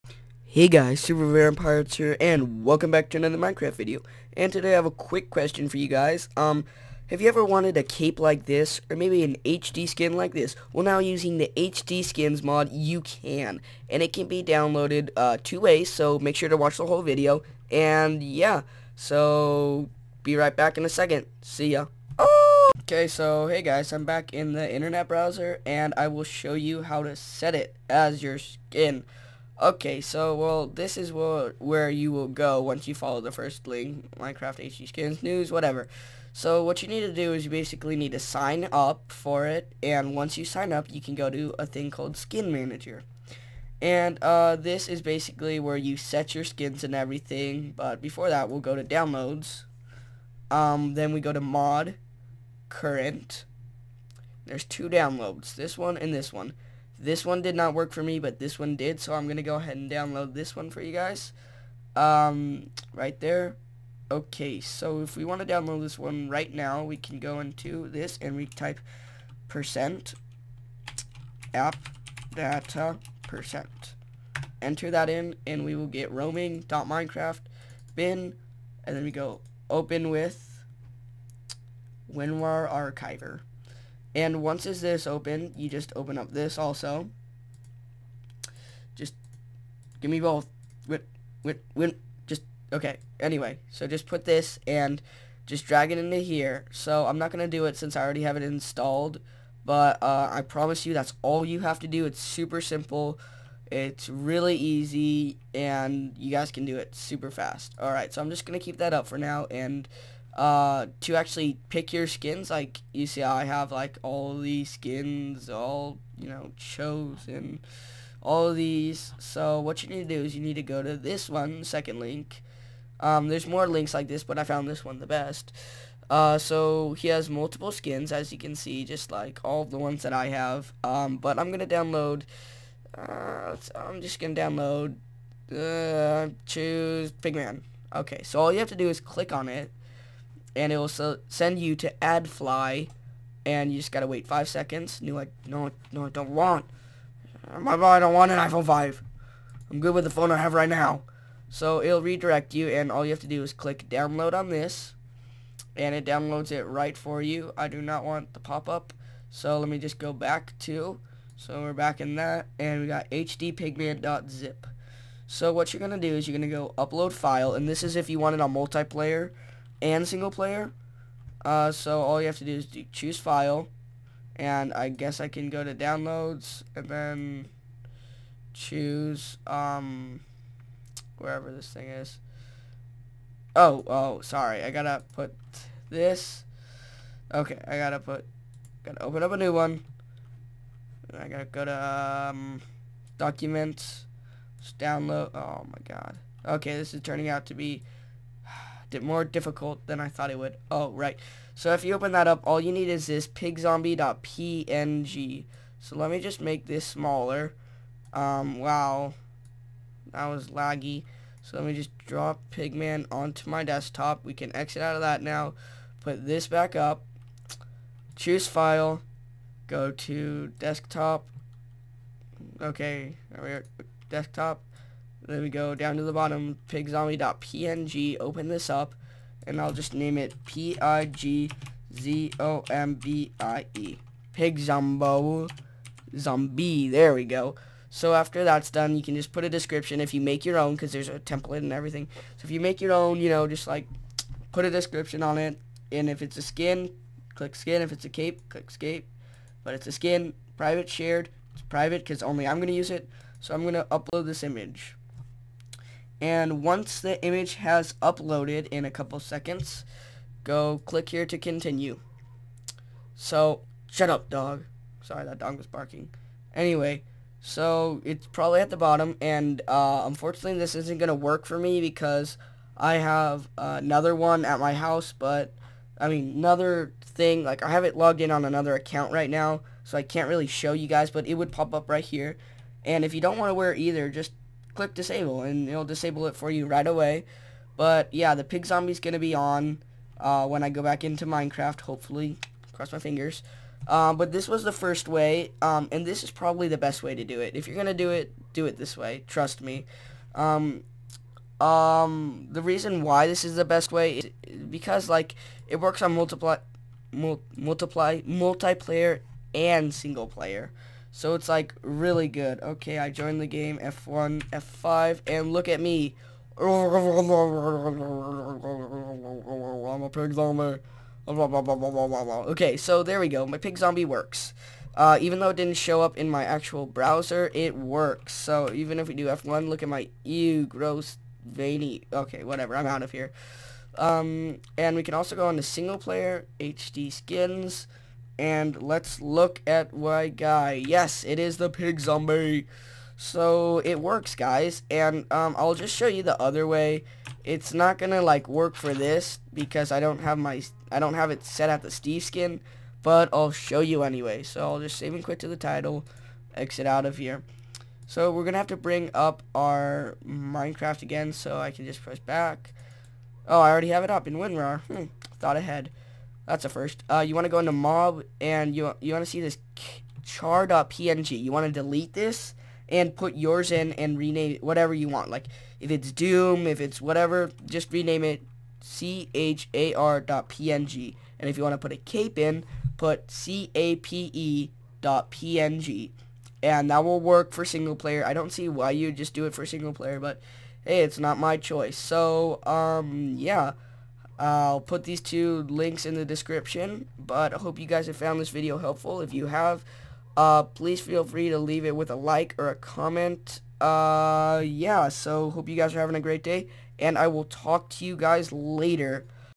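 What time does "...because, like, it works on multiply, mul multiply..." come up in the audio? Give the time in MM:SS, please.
05:04.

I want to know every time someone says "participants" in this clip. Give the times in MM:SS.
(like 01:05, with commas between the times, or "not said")
not said.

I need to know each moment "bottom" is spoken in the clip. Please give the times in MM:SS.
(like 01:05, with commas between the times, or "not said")
03:46, 04:28.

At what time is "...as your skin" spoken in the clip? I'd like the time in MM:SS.
00:27.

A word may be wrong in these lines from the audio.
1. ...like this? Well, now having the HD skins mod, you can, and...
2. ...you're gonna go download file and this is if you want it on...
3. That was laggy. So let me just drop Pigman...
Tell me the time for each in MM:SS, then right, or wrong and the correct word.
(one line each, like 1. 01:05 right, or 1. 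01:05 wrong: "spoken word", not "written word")
1. 00:10 wrong: "using", not "having"
2. 02:46 wrong: "upload", not "download"
3. 03:30 right.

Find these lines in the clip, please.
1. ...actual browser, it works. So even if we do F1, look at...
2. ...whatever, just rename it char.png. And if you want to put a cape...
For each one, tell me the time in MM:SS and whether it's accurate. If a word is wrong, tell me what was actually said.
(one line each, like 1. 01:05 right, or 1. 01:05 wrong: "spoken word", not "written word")
1. 05:26 right
2. 06:17 right.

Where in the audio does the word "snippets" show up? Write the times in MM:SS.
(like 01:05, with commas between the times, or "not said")
not said.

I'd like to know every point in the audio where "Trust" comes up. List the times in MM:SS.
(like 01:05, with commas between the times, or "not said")
04:59.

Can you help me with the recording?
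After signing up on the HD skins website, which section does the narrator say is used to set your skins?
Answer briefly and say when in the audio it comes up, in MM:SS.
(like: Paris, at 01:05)
Skin Manager, at 00:42.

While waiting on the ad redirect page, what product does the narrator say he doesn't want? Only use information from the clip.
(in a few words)
iPhone 5.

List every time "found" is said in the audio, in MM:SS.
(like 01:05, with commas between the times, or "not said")
02:04, 06:38.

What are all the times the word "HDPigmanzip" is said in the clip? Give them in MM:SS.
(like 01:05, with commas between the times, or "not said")
02:43.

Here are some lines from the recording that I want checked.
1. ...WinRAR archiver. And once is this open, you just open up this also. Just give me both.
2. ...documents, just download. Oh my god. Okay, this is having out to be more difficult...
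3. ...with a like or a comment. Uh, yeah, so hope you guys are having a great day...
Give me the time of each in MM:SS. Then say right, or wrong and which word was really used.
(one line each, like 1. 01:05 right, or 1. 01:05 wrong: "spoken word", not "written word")
1. 01:22 right
2. 03:13 wrong: "turning", not "having"
3. 06:41 right.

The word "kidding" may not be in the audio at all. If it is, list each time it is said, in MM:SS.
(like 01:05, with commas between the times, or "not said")
not said.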